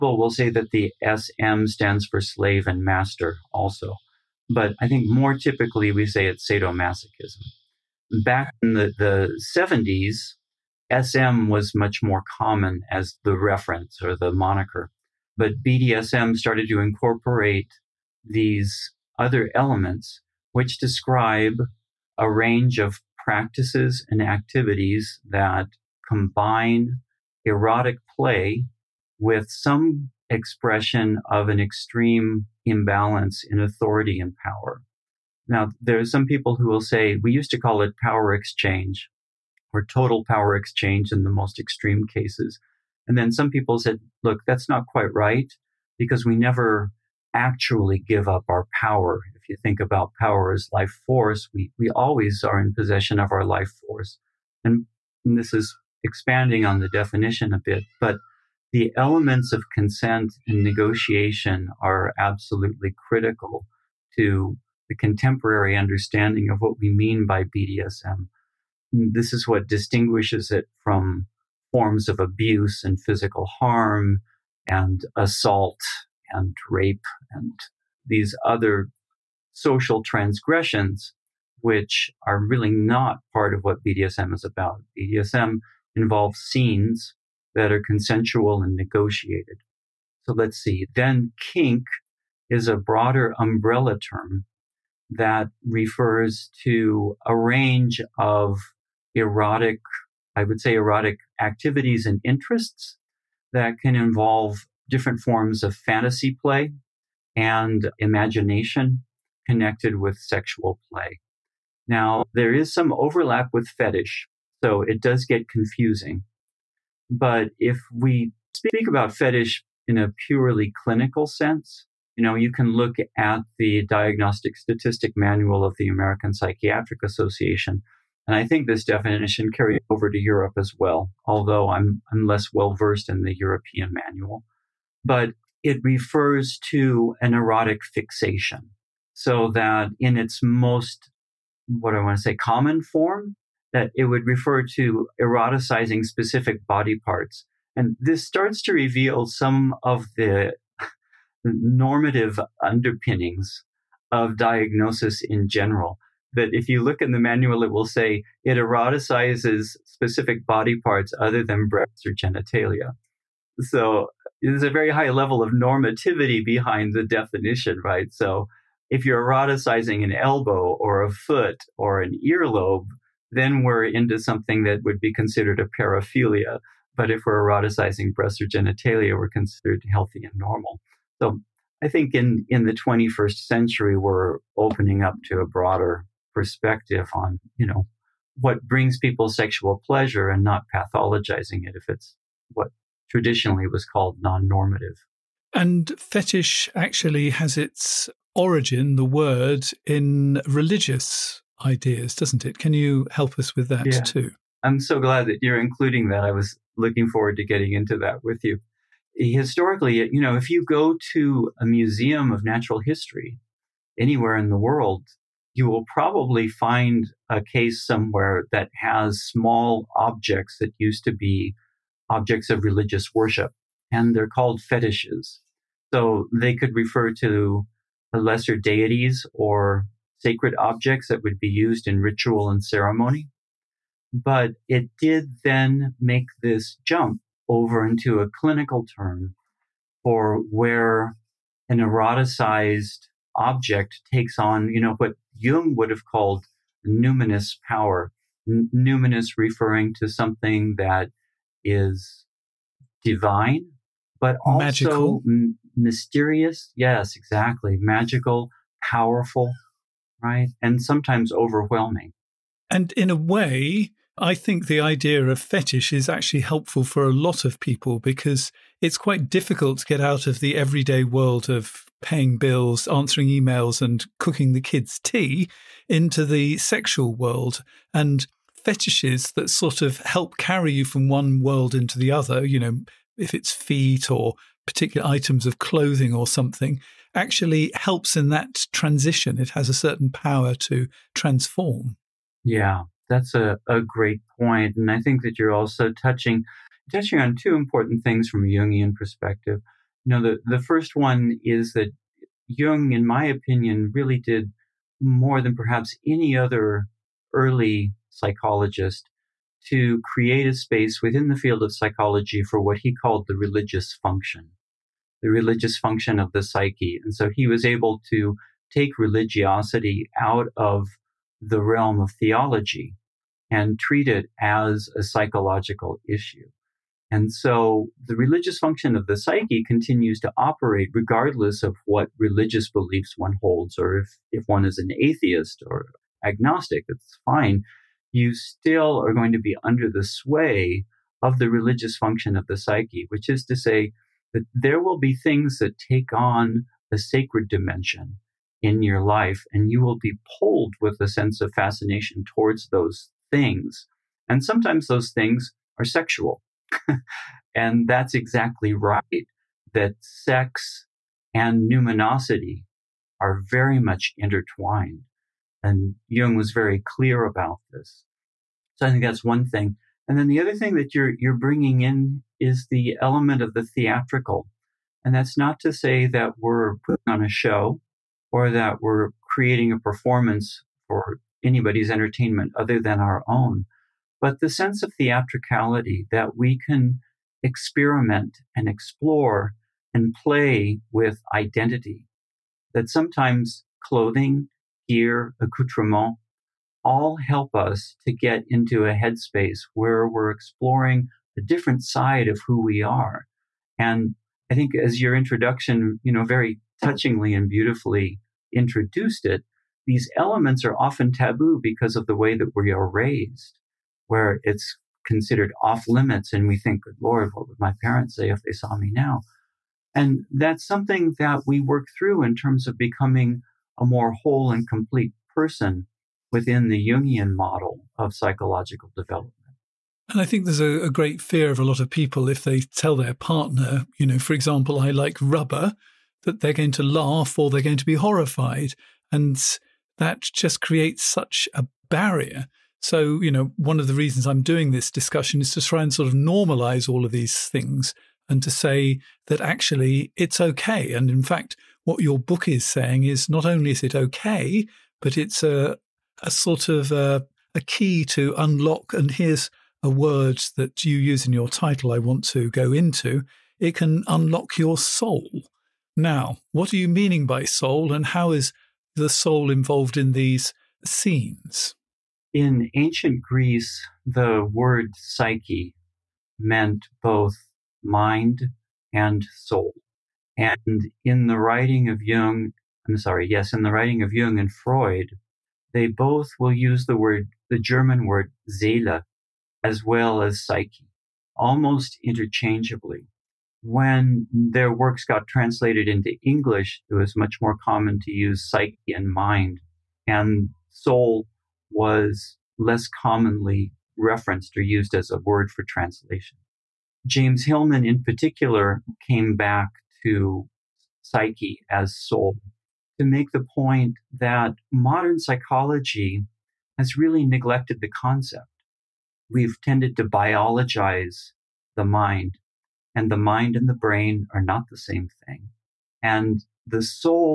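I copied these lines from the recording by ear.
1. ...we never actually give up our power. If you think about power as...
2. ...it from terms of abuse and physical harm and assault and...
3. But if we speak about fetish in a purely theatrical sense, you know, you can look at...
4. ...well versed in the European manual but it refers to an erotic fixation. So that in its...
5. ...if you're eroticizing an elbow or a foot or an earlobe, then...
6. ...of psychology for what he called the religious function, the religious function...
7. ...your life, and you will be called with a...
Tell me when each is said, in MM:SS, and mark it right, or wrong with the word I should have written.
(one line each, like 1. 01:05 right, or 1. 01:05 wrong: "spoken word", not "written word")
1. 00:46 right
2. 01:10 wrong: "forms", not "terms"
3. 01:57 wrong: "clinical", not "theatrical"
4. 02:12 right
5. 02:48 right
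6. 05:11 right
7. 05:48 wrong: "pulled", not "called".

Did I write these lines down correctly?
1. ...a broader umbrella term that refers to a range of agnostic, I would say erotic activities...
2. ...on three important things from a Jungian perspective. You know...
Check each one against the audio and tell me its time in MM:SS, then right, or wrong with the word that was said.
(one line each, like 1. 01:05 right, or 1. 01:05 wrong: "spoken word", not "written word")
1. 01:32 wrong: "erotic", not "agnostic"
2. 04:57 wrong: "two", not "three".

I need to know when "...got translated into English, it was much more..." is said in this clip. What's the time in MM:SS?
08:15.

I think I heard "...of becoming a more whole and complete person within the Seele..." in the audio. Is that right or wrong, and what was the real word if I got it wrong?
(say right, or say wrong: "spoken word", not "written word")
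wrong: "Jungian", not "Seele".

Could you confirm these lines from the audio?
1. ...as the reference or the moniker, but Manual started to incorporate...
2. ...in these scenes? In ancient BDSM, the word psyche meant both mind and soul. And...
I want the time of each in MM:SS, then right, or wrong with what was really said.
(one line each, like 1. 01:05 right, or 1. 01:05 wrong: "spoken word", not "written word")
1. 00:12 wrong: "BDSM", not "Manual"
2. 07:49 wrong: "Greece", not "BDSM".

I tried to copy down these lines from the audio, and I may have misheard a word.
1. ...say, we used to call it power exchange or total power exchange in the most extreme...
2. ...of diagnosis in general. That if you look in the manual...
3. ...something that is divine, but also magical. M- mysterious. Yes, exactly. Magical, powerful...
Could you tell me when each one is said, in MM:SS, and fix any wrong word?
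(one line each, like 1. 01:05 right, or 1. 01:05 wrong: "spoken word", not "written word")
1. 00:36 right
2. 02:34 right
3. 04:10 right.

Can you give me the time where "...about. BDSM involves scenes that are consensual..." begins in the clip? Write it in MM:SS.
01:24.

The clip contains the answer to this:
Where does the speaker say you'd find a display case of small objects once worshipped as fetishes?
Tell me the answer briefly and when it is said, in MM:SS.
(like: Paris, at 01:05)
Museum of natural history, at 03:31.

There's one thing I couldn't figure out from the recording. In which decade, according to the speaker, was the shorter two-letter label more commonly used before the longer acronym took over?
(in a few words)
1970s.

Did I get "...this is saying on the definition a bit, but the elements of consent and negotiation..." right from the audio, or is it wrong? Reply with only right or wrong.
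wrong.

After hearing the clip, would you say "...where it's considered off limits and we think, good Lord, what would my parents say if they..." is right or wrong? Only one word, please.
right.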